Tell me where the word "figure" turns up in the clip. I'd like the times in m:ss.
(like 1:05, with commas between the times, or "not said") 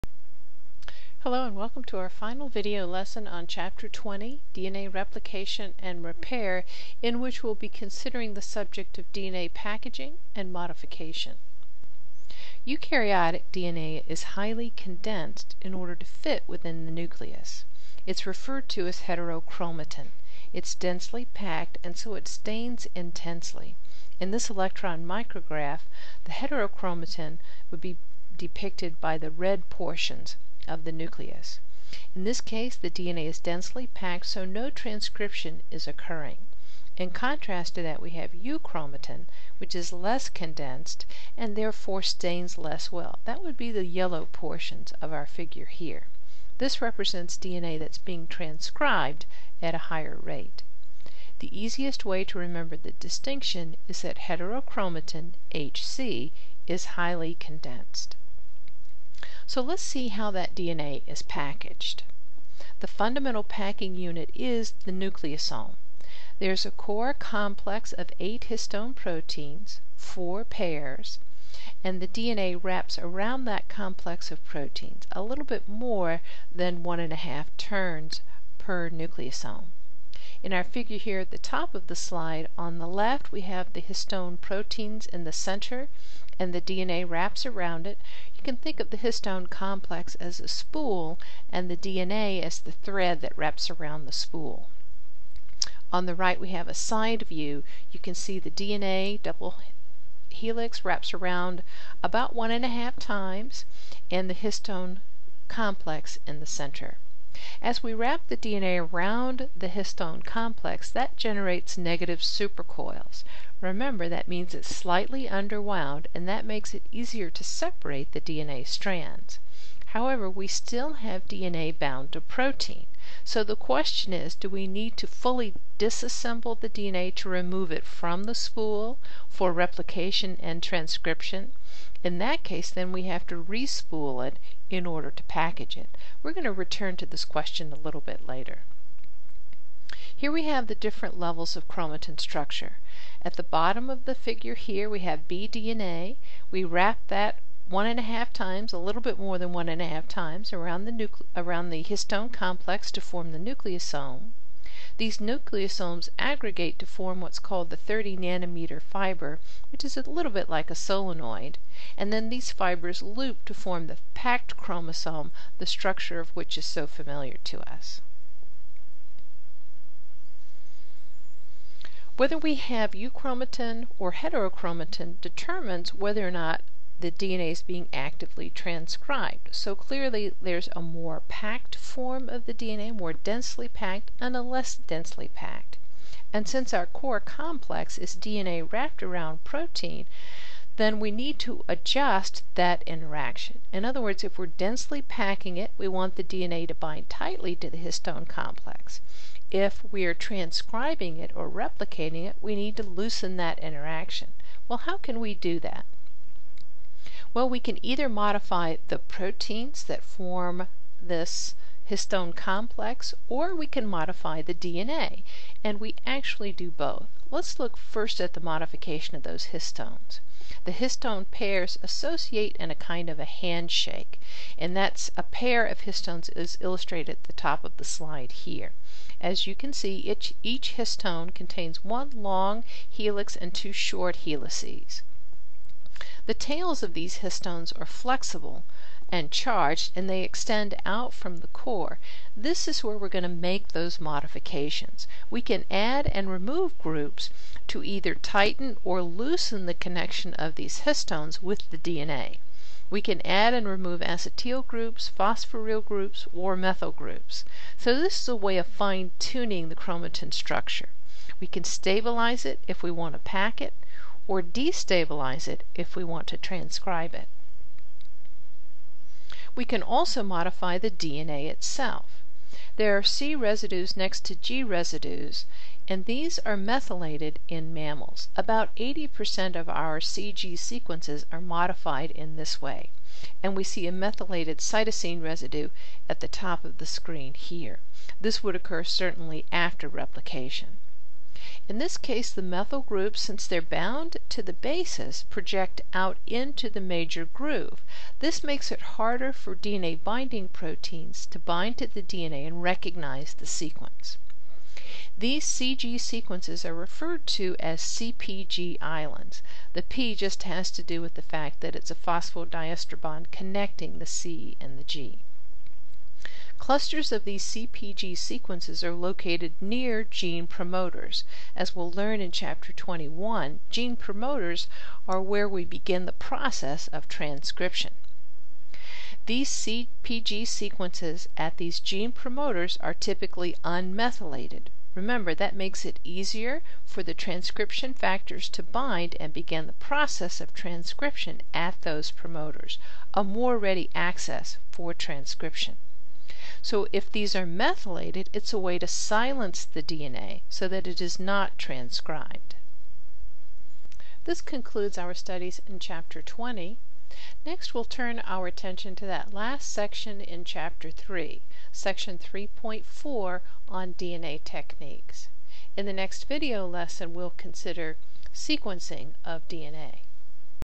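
0:45, 1:20, 2:24.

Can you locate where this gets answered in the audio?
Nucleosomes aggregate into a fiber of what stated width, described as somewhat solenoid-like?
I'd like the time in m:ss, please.
2:37.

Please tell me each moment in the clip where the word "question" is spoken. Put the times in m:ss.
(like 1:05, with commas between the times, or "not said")
2:03, 2:17.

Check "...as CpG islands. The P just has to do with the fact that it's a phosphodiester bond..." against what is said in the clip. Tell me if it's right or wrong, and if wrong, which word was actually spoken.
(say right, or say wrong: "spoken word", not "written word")
right.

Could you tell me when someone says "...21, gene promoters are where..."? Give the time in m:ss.
5:22.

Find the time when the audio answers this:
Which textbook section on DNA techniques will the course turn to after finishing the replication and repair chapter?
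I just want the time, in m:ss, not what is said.
6:01.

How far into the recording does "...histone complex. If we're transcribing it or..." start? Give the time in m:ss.
3:17.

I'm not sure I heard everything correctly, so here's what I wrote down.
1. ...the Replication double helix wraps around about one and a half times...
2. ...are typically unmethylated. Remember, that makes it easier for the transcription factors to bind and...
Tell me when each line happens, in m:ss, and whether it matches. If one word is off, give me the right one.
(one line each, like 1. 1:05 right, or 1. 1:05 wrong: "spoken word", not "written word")
1. 1:38 wrong: "DNA", not "Replication"
2. 5:32 right.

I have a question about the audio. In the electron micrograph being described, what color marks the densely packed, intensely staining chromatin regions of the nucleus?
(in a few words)
red.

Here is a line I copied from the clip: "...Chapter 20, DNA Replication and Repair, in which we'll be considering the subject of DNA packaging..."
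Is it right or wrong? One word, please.
right.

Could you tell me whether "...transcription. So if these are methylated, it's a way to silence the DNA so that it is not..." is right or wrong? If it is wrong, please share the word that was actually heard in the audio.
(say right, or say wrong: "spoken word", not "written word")
right.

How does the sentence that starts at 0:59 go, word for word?
So let's see how that DNA is packaged.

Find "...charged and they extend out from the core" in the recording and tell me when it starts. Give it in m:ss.
3:59.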